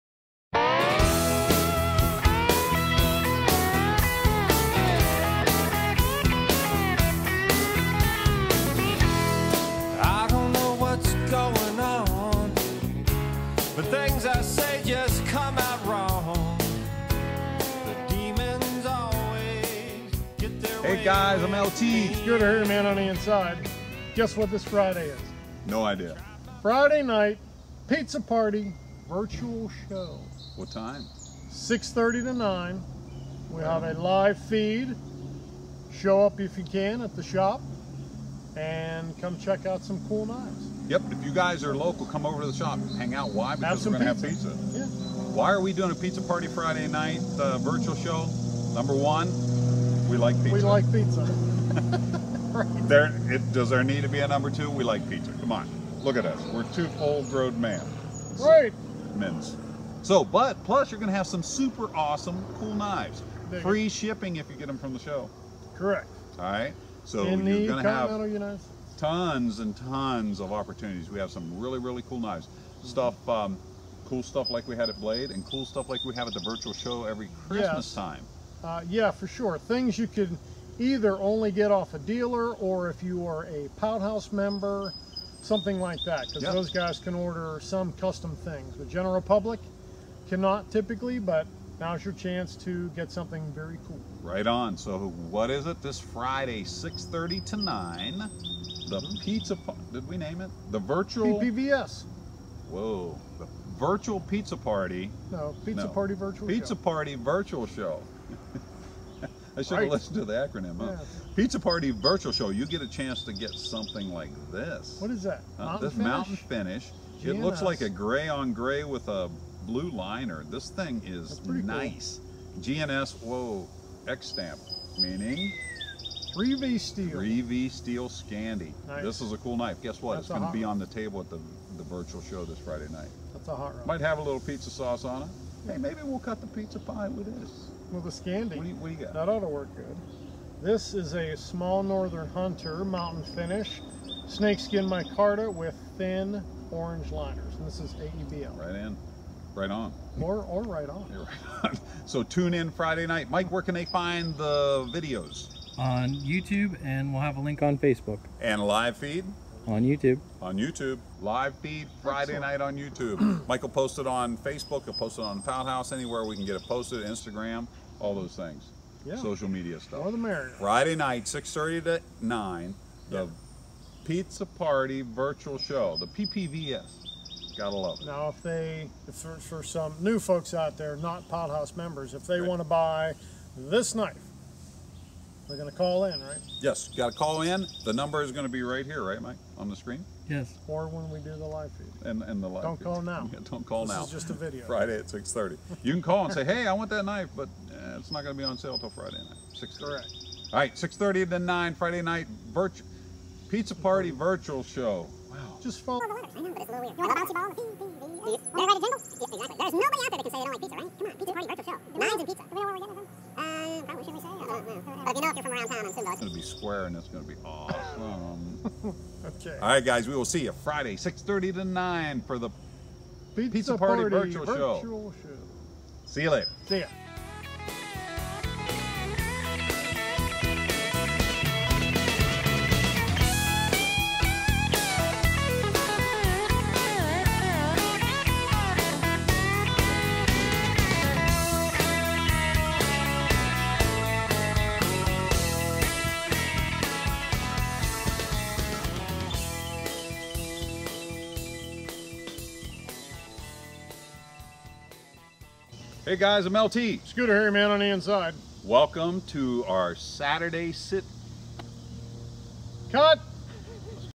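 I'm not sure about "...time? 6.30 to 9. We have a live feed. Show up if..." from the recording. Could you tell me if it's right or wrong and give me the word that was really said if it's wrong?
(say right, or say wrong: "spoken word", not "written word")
right.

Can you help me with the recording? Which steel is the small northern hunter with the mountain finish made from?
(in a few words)
AEBL.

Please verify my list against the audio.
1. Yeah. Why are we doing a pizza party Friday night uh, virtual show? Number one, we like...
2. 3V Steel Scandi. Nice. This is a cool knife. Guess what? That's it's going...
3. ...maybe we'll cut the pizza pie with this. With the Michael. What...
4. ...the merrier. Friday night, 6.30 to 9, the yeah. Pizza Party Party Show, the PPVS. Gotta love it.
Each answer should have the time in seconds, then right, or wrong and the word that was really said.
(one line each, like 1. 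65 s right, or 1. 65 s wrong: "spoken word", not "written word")
1. 44 s right
2. 127 s right
3. 135 s wrong: "Scandi", not "Michael"
4. 170 s wrong: "Virtual", not "Party".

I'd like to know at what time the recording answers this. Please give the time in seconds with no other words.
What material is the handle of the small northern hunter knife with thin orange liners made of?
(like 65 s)
144 s.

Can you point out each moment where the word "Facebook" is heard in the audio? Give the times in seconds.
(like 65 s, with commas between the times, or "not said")
157 s, 164 s.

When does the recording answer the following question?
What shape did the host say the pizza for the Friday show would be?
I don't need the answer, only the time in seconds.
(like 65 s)
216 s.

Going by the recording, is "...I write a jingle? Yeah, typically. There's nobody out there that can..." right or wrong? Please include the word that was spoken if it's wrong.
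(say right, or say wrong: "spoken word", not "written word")
wrong: "exactly", not "typically".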